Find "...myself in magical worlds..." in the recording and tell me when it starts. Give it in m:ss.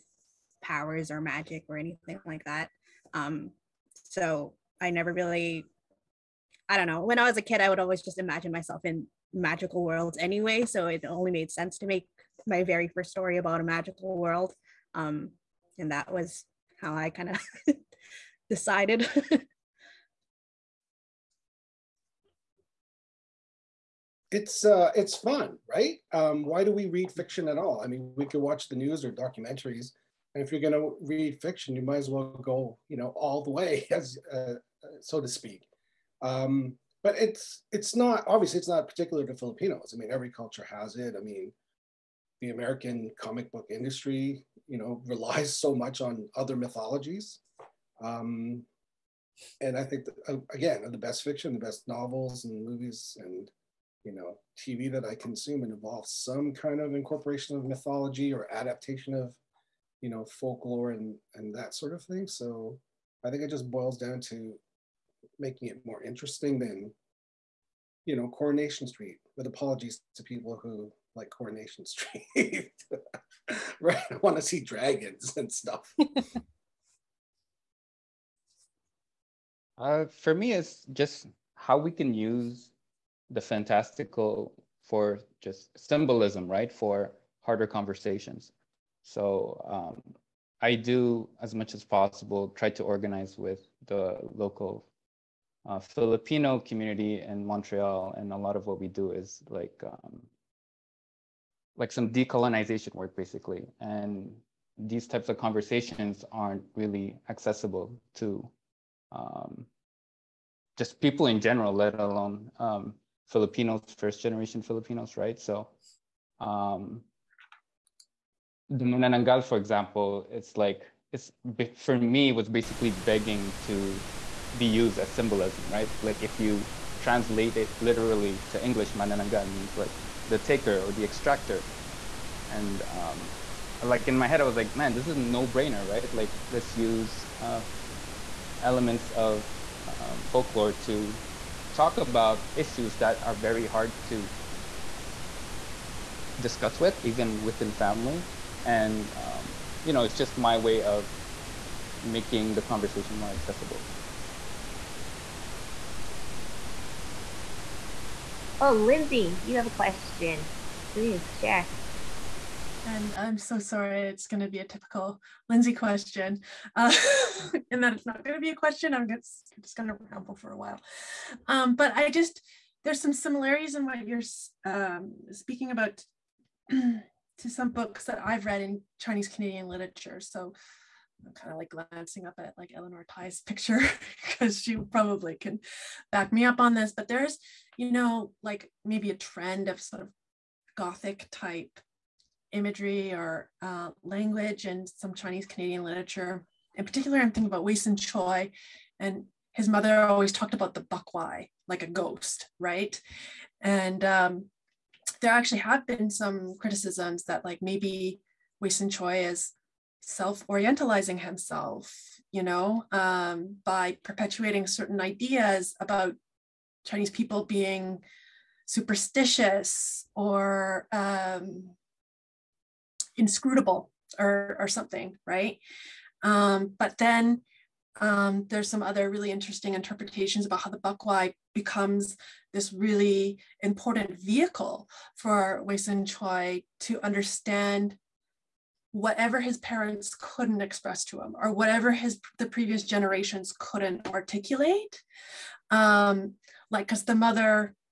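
0:08.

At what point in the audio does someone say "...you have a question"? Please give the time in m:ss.
2:39.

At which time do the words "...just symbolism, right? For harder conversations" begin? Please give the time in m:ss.
1:25.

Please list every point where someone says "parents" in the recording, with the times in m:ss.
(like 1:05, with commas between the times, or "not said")
3:59.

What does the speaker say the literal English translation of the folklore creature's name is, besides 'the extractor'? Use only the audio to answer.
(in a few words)
the taker.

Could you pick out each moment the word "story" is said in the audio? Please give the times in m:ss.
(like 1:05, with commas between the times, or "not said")
0:13.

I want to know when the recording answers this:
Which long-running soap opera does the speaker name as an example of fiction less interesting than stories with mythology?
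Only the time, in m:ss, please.
1:08.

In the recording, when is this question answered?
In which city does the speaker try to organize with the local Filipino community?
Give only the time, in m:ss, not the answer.
1:37.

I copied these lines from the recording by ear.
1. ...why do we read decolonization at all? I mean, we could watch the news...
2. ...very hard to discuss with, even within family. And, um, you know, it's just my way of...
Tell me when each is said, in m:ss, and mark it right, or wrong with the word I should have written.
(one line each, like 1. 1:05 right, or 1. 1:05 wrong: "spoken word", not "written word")
1. 0:26 wrong: "fiction", not "decolonization"
2. 2:23 right.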